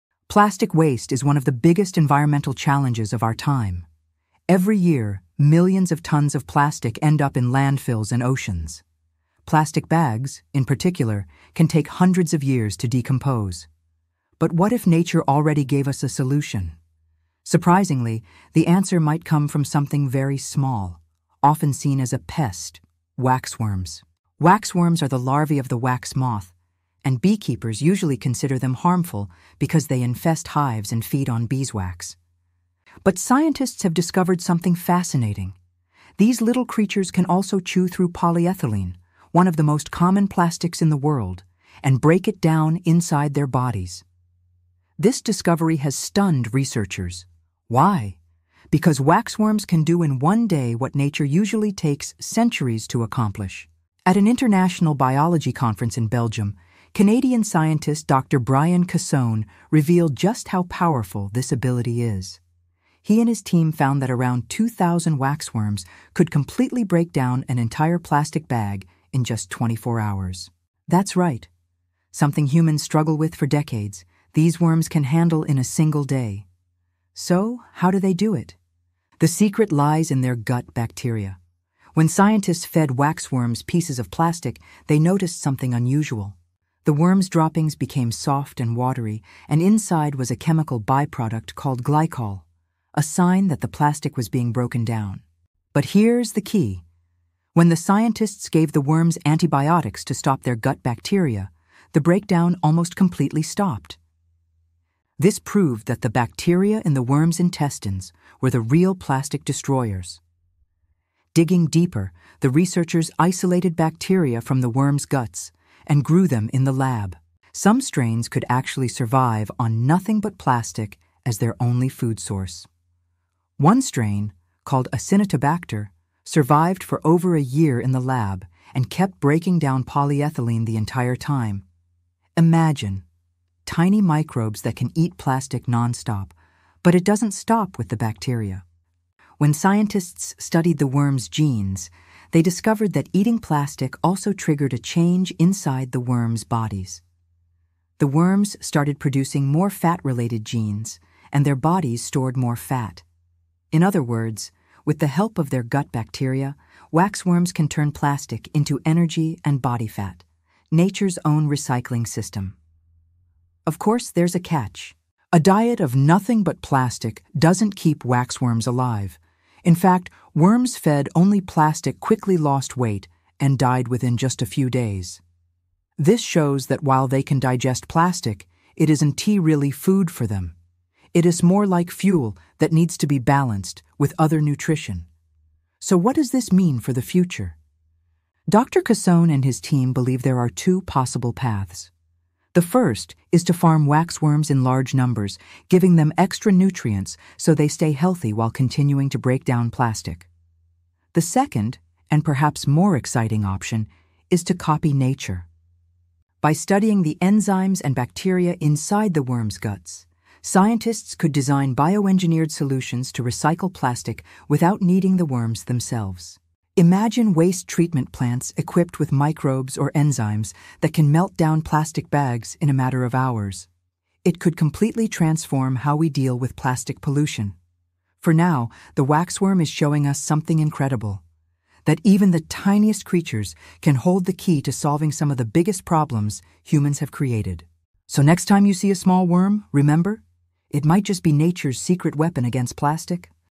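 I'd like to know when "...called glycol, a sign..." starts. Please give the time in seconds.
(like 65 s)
91 s.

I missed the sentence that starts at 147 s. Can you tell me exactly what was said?
The worms started producing more fat related genes, and their bodies stored more fat.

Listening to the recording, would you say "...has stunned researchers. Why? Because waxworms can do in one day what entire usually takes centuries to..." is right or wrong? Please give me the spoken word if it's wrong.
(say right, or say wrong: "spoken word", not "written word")
wrong: "nature", not "entire".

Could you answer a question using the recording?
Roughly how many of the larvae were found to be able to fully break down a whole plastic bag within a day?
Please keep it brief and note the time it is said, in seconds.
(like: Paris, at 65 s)
2,000, at 64 s.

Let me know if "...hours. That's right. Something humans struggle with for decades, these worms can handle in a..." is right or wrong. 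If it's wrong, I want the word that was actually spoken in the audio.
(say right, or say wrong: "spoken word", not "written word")
right.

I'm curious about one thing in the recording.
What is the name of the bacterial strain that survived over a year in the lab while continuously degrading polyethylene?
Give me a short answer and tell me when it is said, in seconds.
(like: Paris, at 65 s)
Acinetobacter, at 124 s.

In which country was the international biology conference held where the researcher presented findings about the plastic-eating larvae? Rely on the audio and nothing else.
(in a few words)
Belgium.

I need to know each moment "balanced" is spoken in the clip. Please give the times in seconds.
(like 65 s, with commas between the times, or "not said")
183 s.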